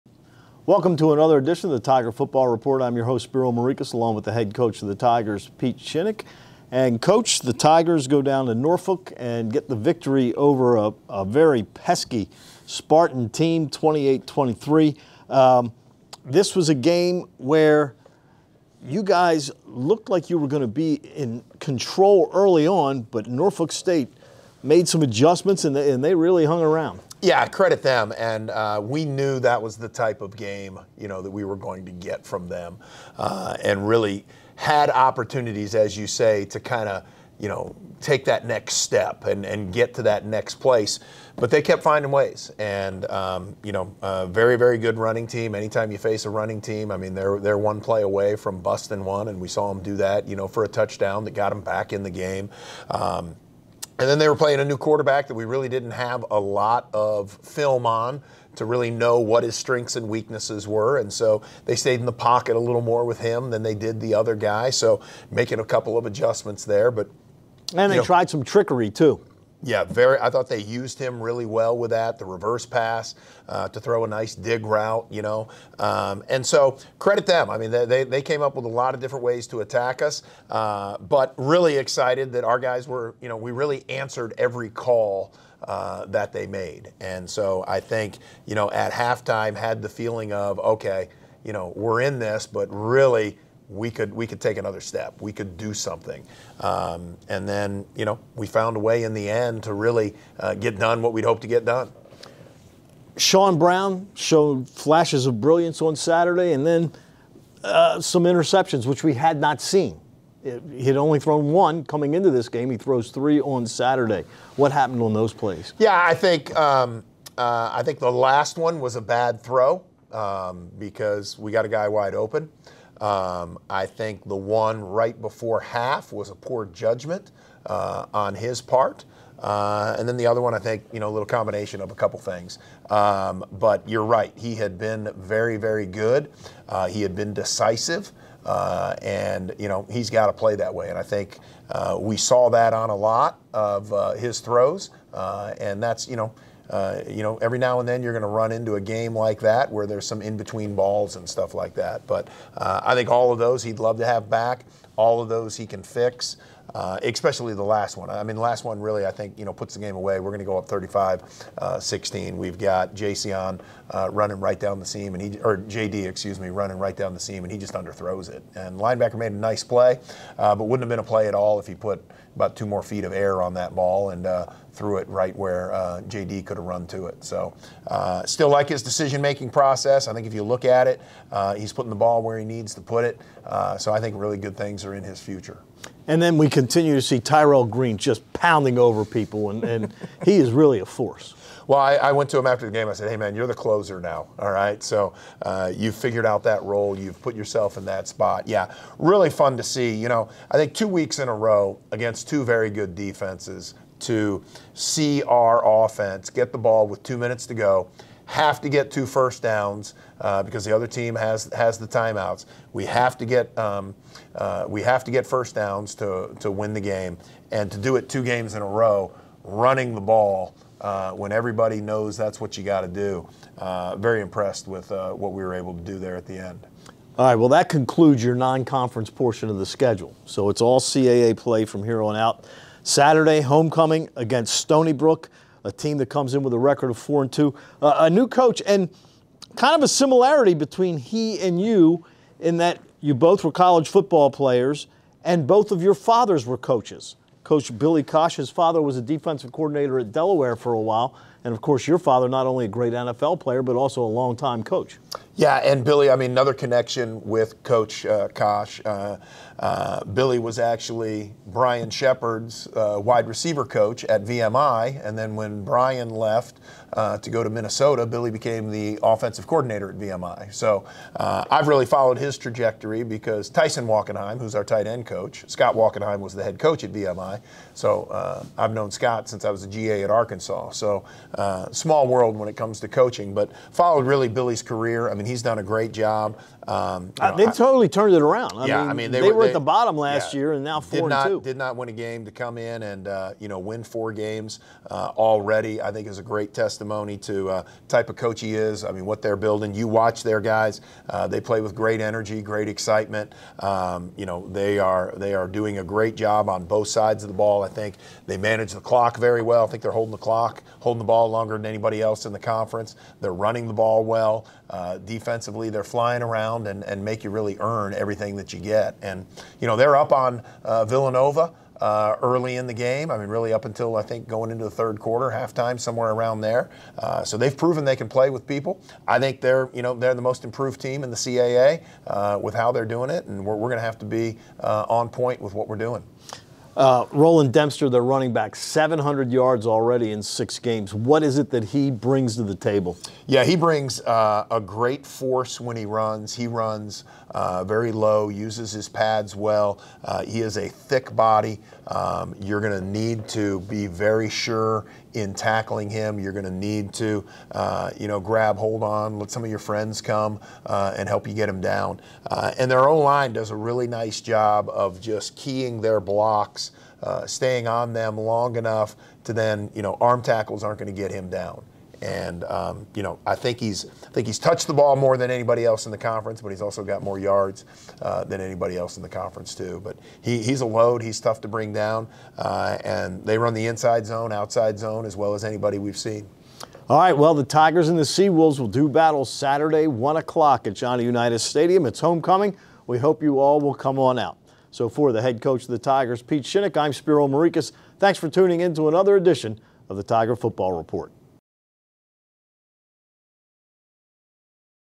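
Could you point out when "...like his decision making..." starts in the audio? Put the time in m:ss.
2:58.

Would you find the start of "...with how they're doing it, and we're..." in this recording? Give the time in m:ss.
5:32.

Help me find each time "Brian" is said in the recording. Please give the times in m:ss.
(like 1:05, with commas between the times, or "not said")
4:21, 4:25.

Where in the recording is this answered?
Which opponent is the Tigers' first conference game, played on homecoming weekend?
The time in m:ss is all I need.
3:54.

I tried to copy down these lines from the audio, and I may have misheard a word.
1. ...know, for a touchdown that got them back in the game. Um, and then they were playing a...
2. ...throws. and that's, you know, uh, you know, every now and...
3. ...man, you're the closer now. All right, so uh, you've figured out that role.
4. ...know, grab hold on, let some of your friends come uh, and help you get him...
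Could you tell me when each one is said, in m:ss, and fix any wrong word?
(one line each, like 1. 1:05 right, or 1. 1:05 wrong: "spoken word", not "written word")
1. 0:50 right
2. 2:24 right
3. 3:13 right
4. 5:58 right.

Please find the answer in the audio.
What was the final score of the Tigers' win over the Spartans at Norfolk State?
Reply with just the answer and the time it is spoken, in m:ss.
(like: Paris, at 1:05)
28-23, at 0:13.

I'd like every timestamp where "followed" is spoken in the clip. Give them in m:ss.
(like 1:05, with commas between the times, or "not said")
4:31, 4:43.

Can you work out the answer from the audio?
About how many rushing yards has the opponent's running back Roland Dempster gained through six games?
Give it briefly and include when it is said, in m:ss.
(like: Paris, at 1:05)
700, at 5:38.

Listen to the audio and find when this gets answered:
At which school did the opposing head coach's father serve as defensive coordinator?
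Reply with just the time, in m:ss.
4:10.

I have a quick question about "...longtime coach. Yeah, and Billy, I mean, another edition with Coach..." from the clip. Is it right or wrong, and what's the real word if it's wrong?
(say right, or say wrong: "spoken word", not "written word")
wrong: "connection", not "edition".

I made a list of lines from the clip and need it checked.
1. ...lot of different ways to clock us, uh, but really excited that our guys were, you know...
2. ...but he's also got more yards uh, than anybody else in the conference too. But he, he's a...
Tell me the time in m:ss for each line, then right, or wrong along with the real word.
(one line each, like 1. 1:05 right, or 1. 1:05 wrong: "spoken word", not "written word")
1. 1:18 wrong: "attack", not "clock"
2. 6:16 right.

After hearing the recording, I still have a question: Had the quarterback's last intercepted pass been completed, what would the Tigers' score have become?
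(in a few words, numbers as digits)
35-16.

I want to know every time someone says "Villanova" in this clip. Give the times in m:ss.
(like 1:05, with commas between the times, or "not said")
5:20.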